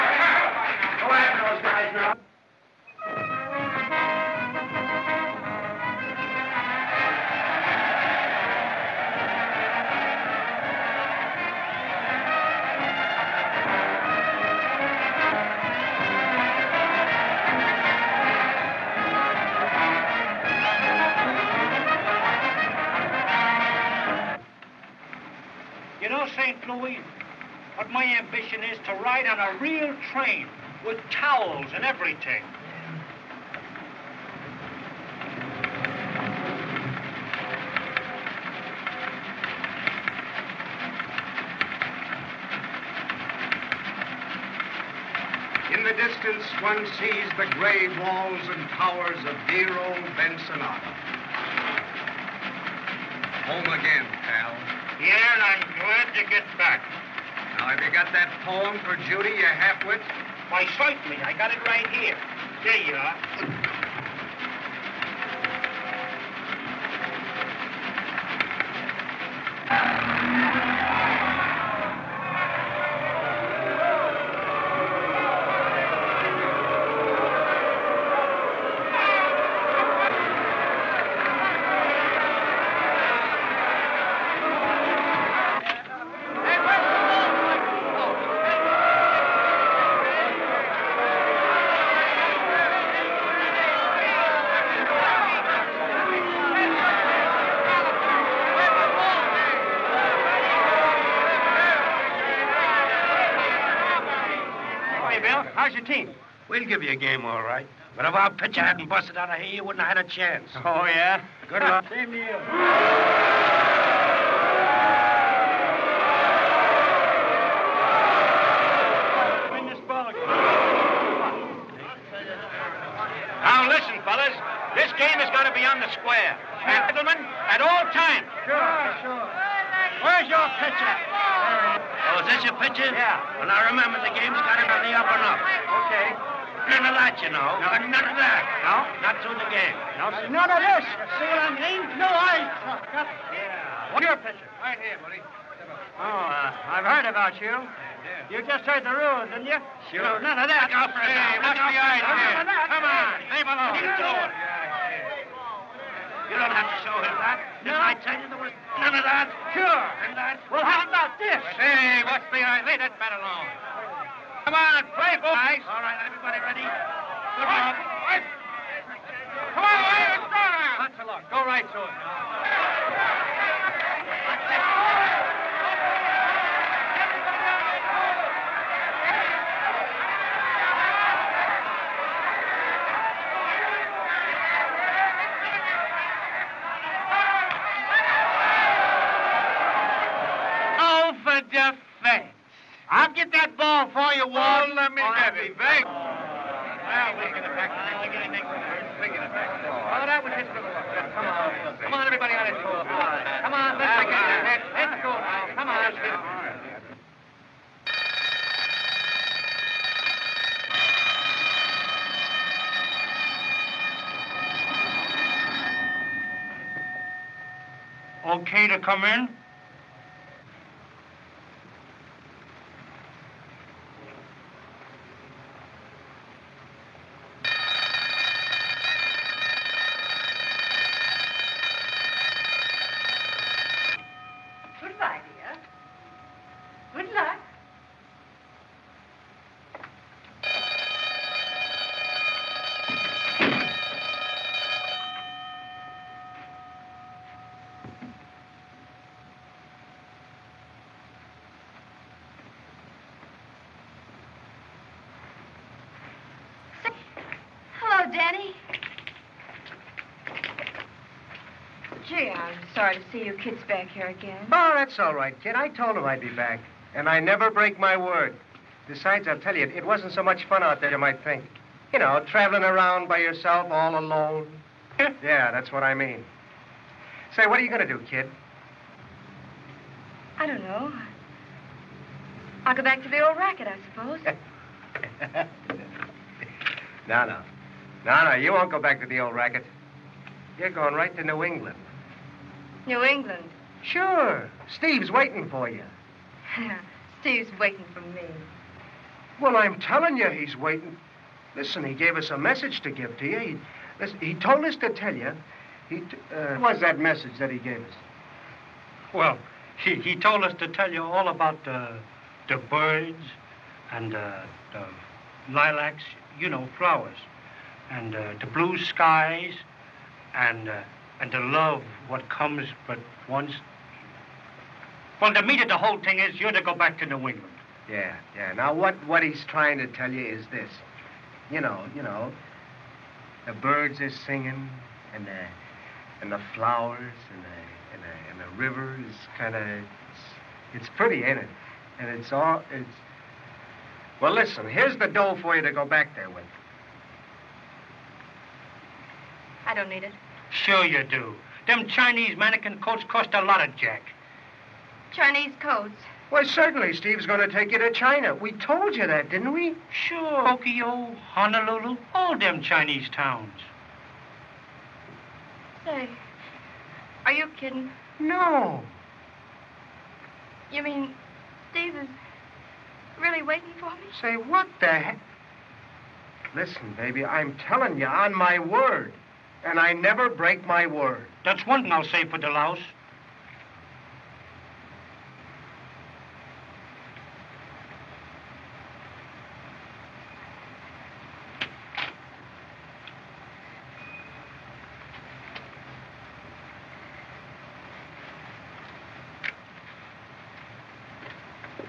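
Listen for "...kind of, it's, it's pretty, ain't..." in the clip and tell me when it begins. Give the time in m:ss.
5:39.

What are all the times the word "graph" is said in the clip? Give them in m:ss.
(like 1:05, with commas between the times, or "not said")
not said.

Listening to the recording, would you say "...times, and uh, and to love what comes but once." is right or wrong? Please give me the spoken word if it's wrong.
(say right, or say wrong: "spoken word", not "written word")
wrong: "skies", not "times".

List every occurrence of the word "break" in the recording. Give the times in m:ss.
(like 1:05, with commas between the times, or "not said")
4:27, 6:20.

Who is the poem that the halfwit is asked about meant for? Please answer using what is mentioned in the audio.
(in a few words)
Judy.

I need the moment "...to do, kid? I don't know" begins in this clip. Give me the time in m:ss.
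4:37.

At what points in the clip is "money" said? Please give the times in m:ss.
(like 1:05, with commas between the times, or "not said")
not said.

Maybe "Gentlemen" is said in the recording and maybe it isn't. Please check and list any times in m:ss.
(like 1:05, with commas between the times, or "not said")
2:06.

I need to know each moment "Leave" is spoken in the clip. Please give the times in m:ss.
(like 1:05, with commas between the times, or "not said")
2:33, 2:42.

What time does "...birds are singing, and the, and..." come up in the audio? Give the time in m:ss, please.
5:33.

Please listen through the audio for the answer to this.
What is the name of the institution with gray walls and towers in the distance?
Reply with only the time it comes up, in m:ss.
0:50.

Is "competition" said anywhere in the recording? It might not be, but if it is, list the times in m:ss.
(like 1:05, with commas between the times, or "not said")
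not said.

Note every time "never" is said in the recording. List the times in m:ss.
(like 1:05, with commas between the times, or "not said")
4:27, 6:19.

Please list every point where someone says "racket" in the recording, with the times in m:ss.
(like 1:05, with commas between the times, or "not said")
4:43, 4:49.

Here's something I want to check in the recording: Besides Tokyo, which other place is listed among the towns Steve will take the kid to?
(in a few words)
Honolulu.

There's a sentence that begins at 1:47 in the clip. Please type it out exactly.
But if our pitcher hadn't busted out of here, you wouldn't have had a chance.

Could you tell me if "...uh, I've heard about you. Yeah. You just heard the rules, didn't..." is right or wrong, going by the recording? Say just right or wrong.
right.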